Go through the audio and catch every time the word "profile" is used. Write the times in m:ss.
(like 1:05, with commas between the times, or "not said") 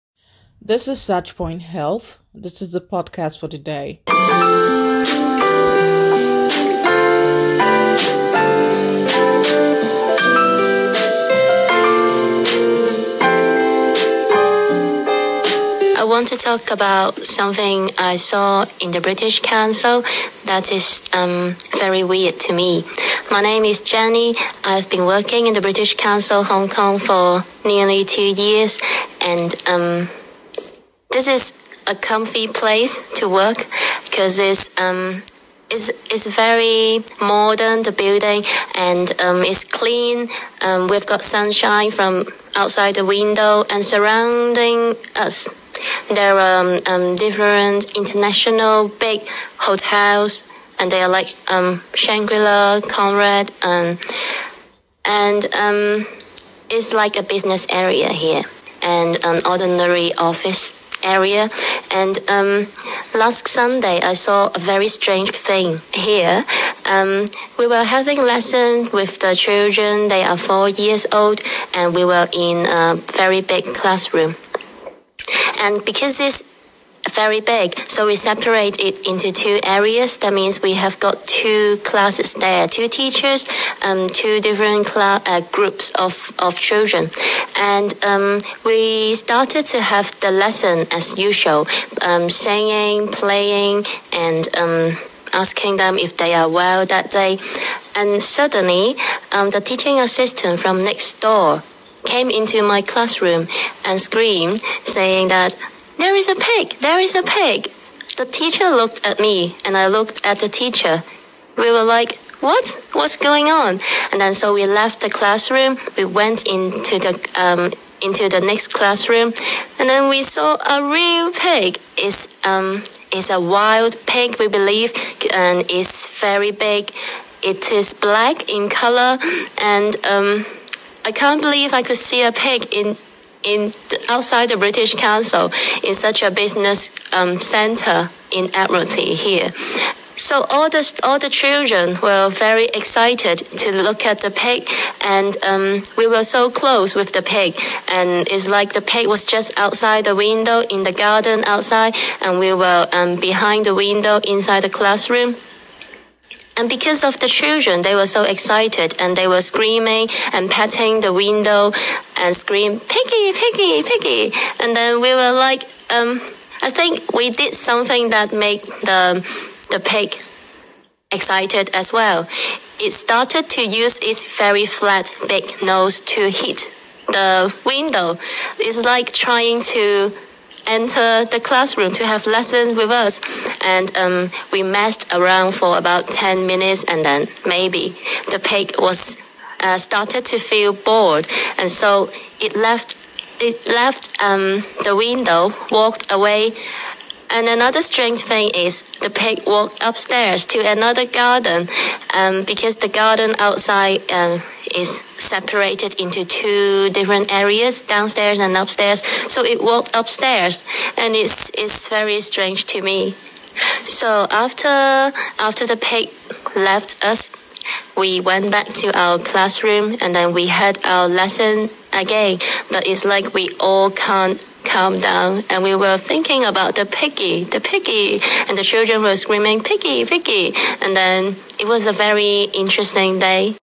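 not said.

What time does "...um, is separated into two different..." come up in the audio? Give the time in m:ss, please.
3:24.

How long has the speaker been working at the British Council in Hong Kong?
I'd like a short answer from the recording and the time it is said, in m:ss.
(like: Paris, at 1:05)
nearly 2 years, at 0:27.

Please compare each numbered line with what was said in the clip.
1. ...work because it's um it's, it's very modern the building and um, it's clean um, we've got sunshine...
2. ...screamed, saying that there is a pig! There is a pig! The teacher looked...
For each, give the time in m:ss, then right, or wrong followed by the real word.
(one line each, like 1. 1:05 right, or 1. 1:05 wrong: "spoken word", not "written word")
1. 0:33 right
2. 1:44 right.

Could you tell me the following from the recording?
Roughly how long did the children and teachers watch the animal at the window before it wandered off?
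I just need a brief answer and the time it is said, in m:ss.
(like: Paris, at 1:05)
10 minutes, at 3:06.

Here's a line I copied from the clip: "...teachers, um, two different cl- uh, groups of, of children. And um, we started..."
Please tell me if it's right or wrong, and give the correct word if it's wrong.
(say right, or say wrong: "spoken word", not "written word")
right.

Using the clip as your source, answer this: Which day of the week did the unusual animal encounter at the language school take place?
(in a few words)
Sunday.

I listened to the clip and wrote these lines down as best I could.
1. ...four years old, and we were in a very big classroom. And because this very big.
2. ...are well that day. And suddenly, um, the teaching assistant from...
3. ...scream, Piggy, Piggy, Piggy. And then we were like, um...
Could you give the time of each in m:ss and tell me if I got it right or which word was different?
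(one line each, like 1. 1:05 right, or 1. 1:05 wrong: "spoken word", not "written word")
1. 1:10 right
2. 1:36 right
3. 2:42 right.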